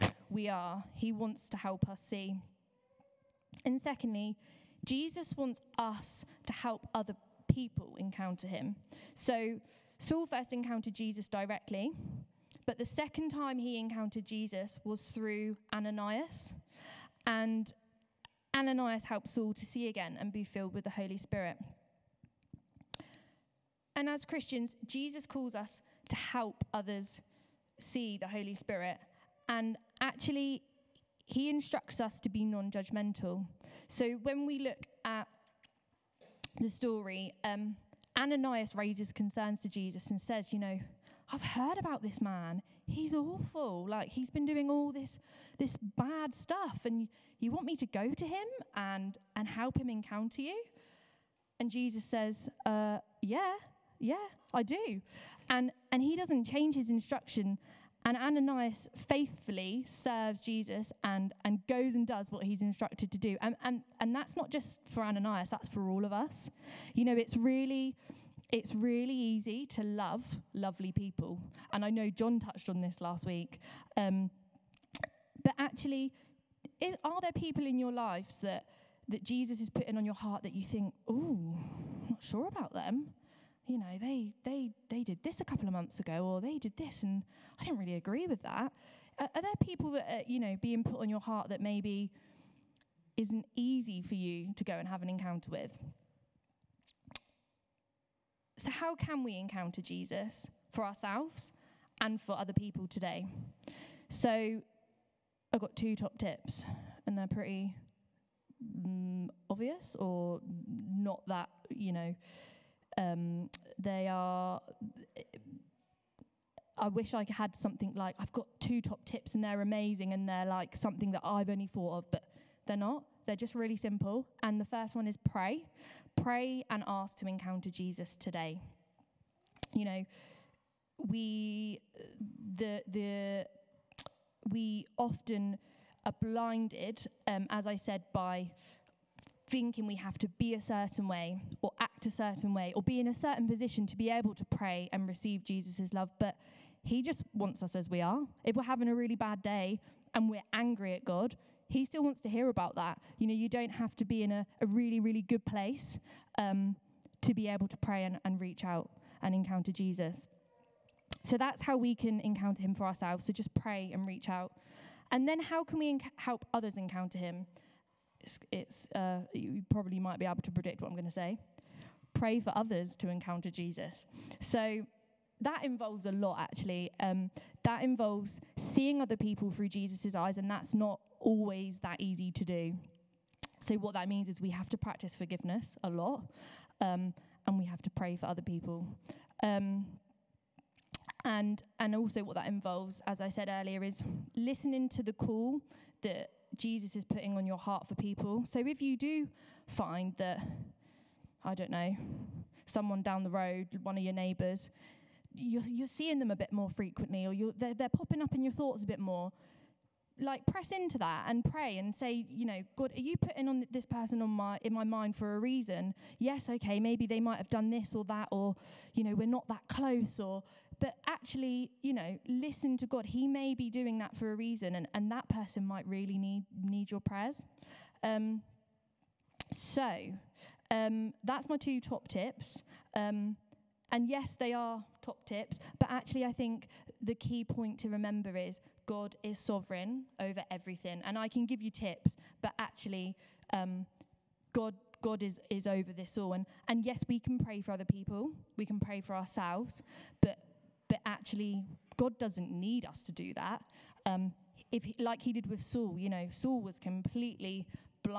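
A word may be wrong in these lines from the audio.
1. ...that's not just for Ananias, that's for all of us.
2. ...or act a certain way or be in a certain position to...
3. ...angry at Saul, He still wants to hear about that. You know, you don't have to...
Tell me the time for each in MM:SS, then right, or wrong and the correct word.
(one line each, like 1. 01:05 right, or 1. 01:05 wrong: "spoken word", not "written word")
1. 01:04 right
2. 02:21 right
3. 02:30 wrong: "God", not "Saul".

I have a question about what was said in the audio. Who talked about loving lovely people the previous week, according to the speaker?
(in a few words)
John.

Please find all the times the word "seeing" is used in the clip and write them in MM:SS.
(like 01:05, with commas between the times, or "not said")
02:58, 03:25.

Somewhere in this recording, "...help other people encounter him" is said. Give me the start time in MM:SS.
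00:06.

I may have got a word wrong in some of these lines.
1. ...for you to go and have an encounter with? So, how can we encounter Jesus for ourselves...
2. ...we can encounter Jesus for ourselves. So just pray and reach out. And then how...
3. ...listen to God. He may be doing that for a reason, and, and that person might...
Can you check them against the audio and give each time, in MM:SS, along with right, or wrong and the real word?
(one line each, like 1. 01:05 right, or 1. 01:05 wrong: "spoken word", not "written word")
1. 01:34 right
2. 02:41 wrong: "Him", not "Jesus"
3. 03:42 right.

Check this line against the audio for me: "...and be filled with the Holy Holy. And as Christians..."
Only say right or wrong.
wrong.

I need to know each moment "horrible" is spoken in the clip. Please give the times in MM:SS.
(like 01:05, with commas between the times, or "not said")
not said.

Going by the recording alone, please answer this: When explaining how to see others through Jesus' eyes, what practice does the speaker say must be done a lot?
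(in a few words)
Forgiveness.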